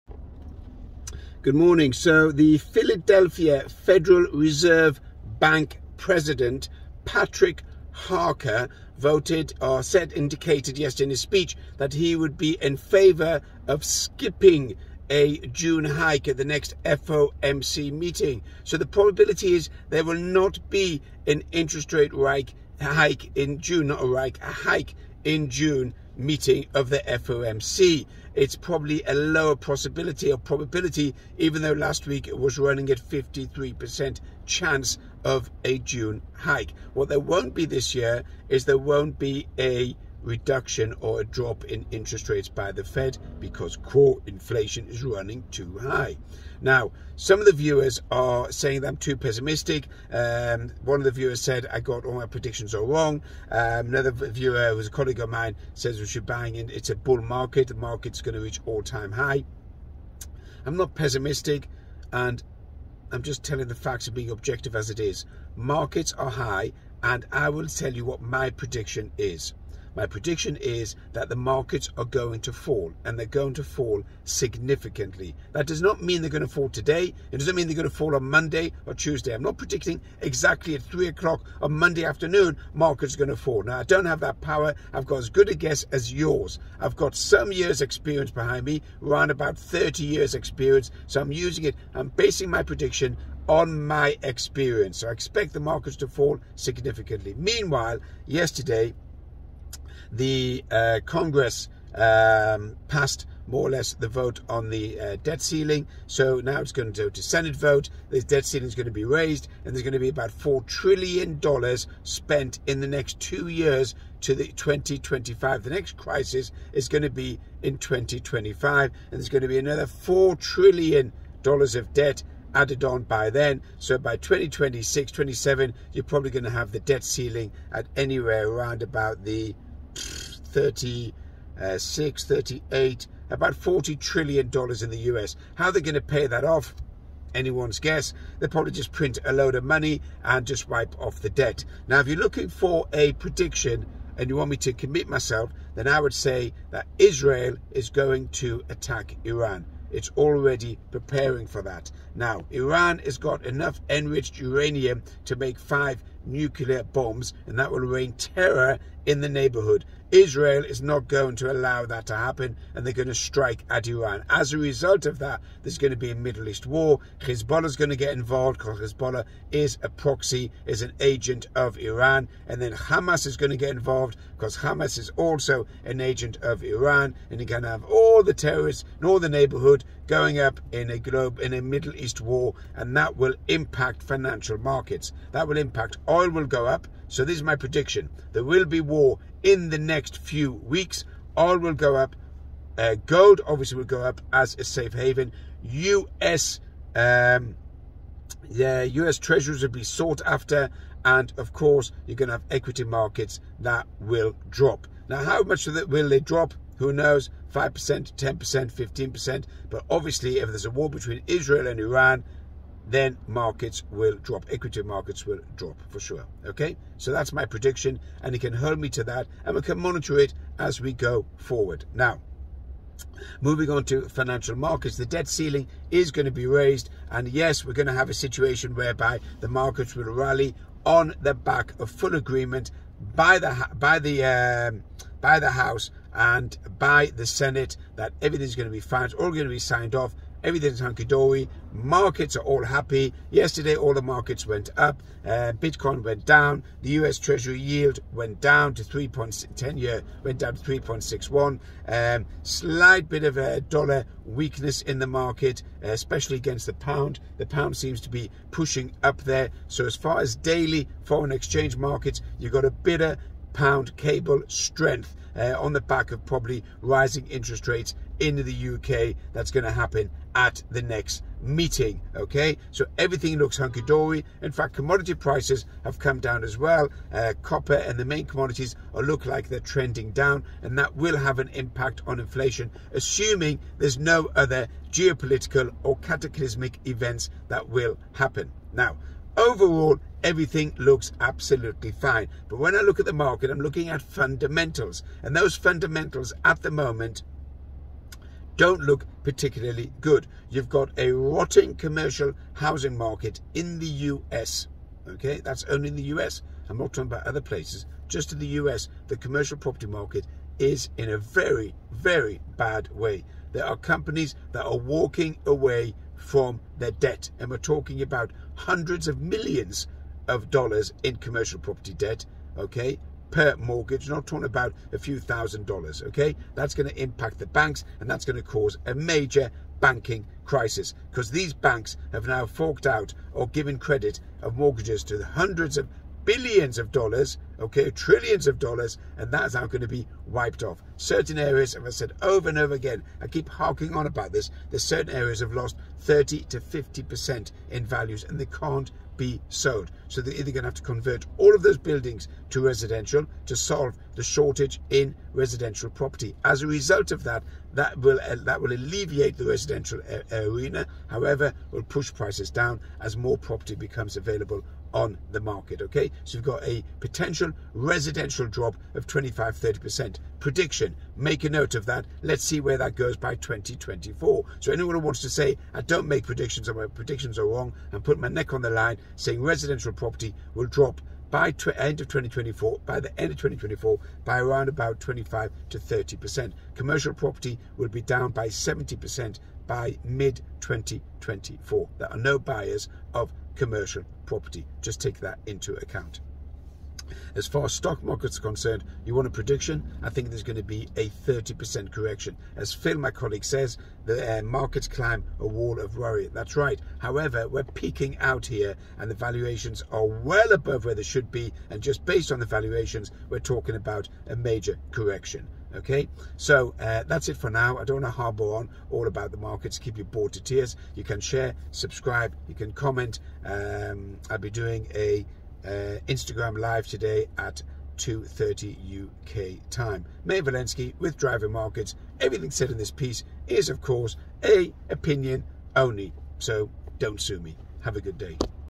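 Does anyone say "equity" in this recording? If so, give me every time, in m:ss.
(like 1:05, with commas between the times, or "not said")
3:22, 3:34.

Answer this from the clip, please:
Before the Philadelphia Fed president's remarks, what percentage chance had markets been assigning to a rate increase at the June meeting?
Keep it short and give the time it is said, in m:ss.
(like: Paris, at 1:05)
53%, at 0:32.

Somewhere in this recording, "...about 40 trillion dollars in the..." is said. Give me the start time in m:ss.
2:13.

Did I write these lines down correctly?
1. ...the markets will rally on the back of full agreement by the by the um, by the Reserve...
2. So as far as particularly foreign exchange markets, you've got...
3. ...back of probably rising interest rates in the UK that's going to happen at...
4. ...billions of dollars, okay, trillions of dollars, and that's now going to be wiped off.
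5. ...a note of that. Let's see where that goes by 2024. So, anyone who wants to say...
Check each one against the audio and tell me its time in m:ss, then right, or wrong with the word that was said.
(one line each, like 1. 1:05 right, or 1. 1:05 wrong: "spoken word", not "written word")
1. 3:49 wrong: "House", not "Reserve"
2. 4:19 wrong: "daily", not "particularly"
3. 4:25 right
4. 5:36 right
5. 6:11 right.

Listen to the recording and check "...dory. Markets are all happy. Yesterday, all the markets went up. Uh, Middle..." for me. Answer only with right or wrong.
wrong.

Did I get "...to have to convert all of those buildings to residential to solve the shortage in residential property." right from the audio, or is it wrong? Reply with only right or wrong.
right.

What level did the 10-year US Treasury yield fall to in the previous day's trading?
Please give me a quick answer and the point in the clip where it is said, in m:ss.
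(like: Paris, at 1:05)
3.61, at 4:10.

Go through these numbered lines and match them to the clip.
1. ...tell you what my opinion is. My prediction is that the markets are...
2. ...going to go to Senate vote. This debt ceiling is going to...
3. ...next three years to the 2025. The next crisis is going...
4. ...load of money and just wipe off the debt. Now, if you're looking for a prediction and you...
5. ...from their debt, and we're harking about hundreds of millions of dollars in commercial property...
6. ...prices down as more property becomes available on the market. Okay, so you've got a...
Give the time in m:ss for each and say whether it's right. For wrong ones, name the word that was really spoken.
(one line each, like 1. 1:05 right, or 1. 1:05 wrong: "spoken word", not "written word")
1. 1:07 wrong: "prediction", not "opinion"
2. 1:46 right
3. 1:52 wrong: "two", not "three"
4. 2:19 right
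5. 5:16 wrong: "talking", not "harking"
6. 6:02 right.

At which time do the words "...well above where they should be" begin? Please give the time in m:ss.
6:50.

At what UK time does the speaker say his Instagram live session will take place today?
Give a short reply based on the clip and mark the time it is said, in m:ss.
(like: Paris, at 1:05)
2:30, at 7:07.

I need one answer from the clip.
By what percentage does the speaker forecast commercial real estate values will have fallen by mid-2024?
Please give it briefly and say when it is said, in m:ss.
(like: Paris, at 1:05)
70%, at 6:28.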